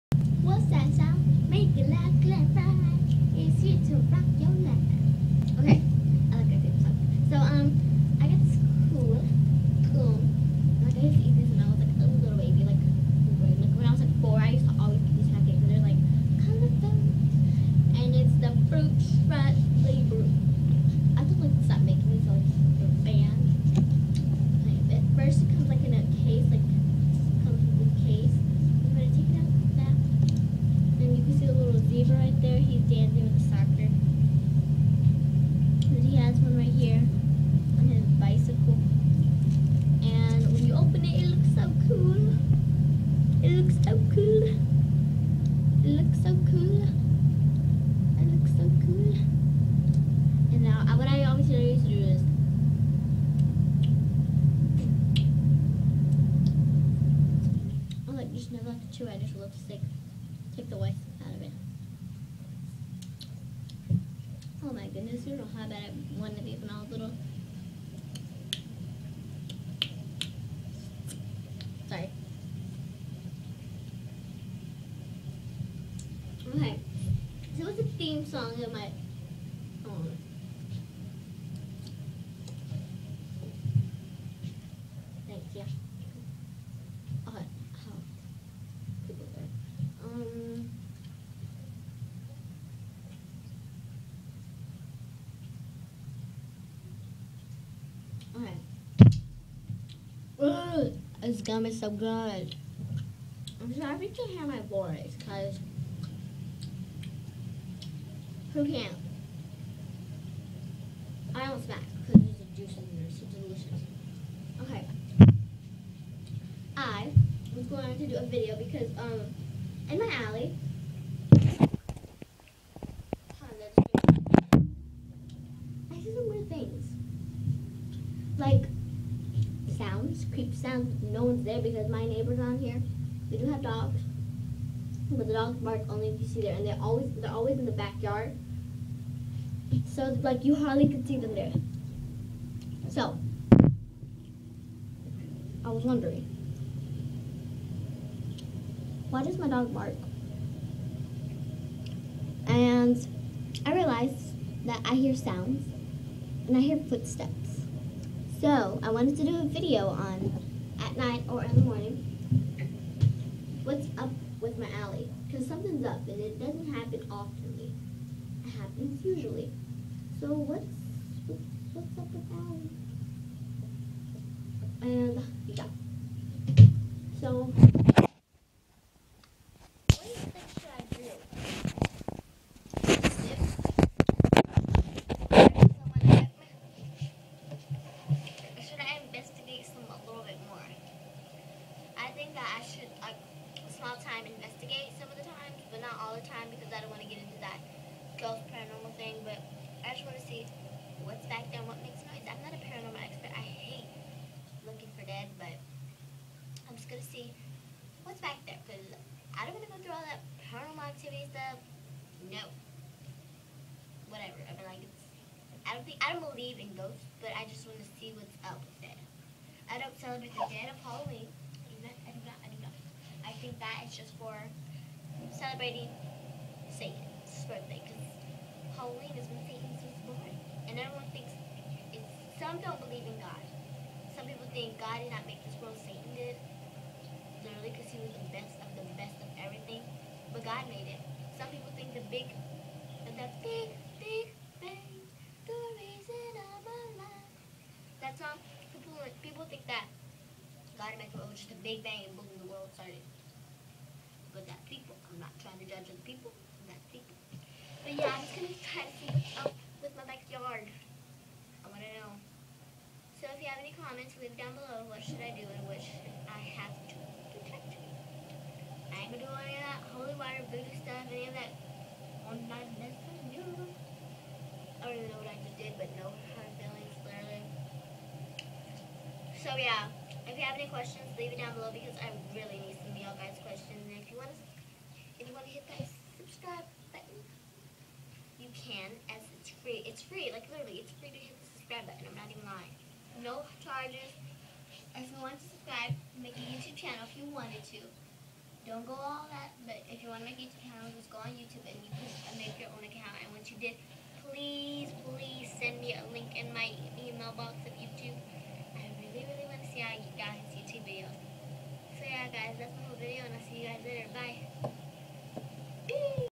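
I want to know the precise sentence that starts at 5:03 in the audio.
And once you did, please, please send me a link in my email box of YouTube Ciagi guys YouTube video.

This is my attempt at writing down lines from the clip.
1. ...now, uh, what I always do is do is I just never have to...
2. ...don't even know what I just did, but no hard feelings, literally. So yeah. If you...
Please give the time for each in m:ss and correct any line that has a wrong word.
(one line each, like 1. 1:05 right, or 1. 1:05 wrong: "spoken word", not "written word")
1. 0:50 right
2. 4:34 right.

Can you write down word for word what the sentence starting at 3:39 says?
I don't celebrate the dead of Halloween think that is just for celebrating Satan's birthday because Halloween is when Satan's was born.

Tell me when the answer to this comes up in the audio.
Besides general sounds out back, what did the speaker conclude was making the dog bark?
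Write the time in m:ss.
2:36.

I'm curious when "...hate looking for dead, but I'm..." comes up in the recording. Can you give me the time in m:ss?
3:23.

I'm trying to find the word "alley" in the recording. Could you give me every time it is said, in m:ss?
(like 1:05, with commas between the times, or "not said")
2:00, 2:44, 2:54.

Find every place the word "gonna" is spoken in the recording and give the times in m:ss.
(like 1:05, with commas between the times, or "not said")
1:41, 3:26, 4:18, 4:29.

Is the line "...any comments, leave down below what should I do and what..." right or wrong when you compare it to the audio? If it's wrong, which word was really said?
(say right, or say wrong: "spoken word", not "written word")
right.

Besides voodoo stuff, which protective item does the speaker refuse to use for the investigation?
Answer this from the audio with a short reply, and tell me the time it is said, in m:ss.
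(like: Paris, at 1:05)
Holy water, at 4:29.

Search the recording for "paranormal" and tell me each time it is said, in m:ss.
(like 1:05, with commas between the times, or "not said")
3:18, 3:22, 3:30.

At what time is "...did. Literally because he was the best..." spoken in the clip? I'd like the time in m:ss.
3:56.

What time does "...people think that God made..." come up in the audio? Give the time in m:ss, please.
4:09.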